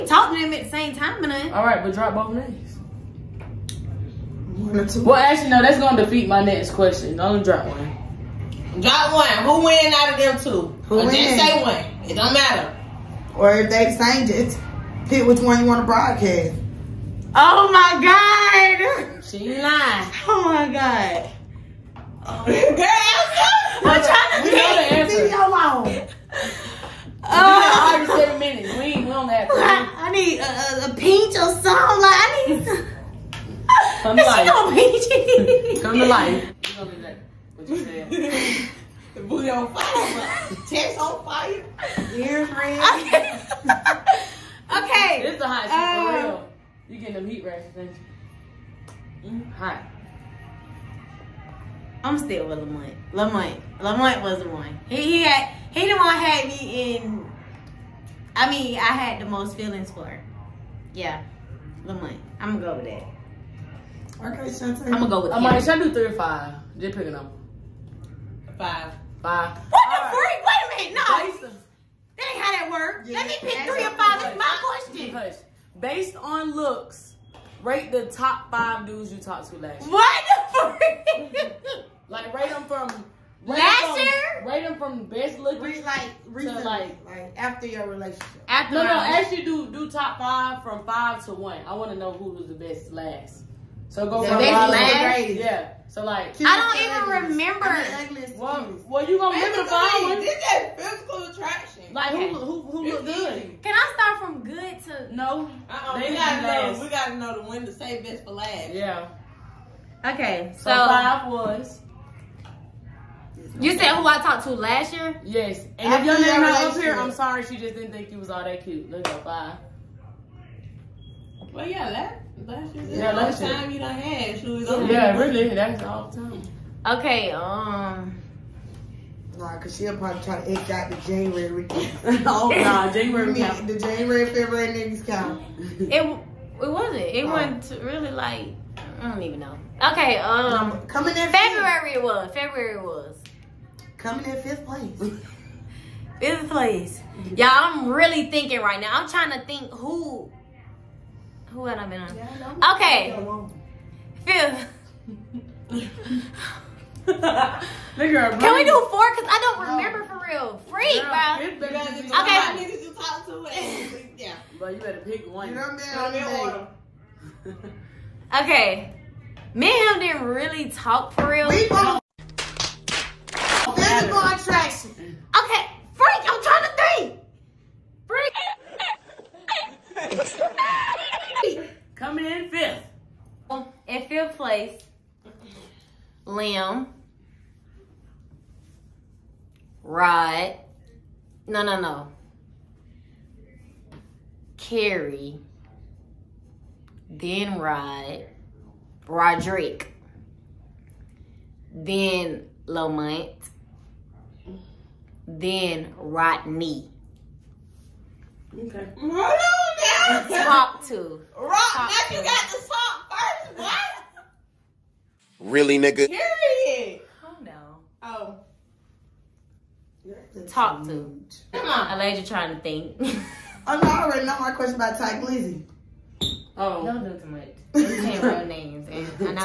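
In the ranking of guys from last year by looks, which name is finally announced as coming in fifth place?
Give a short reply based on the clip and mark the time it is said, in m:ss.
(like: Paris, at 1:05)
Liam, at 3:06.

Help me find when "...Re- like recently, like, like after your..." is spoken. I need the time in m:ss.
1:25.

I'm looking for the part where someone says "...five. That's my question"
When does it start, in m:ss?
1:13.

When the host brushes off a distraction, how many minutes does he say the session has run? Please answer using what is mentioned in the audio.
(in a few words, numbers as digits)
7 minutes.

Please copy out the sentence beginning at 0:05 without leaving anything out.
Well, actually, no, that's gonna defeat my next question.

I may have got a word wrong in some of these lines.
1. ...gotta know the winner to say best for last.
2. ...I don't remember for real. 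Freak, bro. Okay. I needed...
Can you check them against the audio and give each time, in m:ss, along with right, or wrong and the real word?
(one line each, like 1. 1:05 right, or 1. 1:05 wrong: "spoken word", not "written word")
1. 1:46 right
2. 2:39 right.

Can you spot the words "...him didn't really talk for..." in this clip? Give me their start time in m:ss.
2:50.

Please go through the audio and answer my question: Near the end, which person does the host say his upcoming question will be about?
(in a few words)
Ty Glizzy.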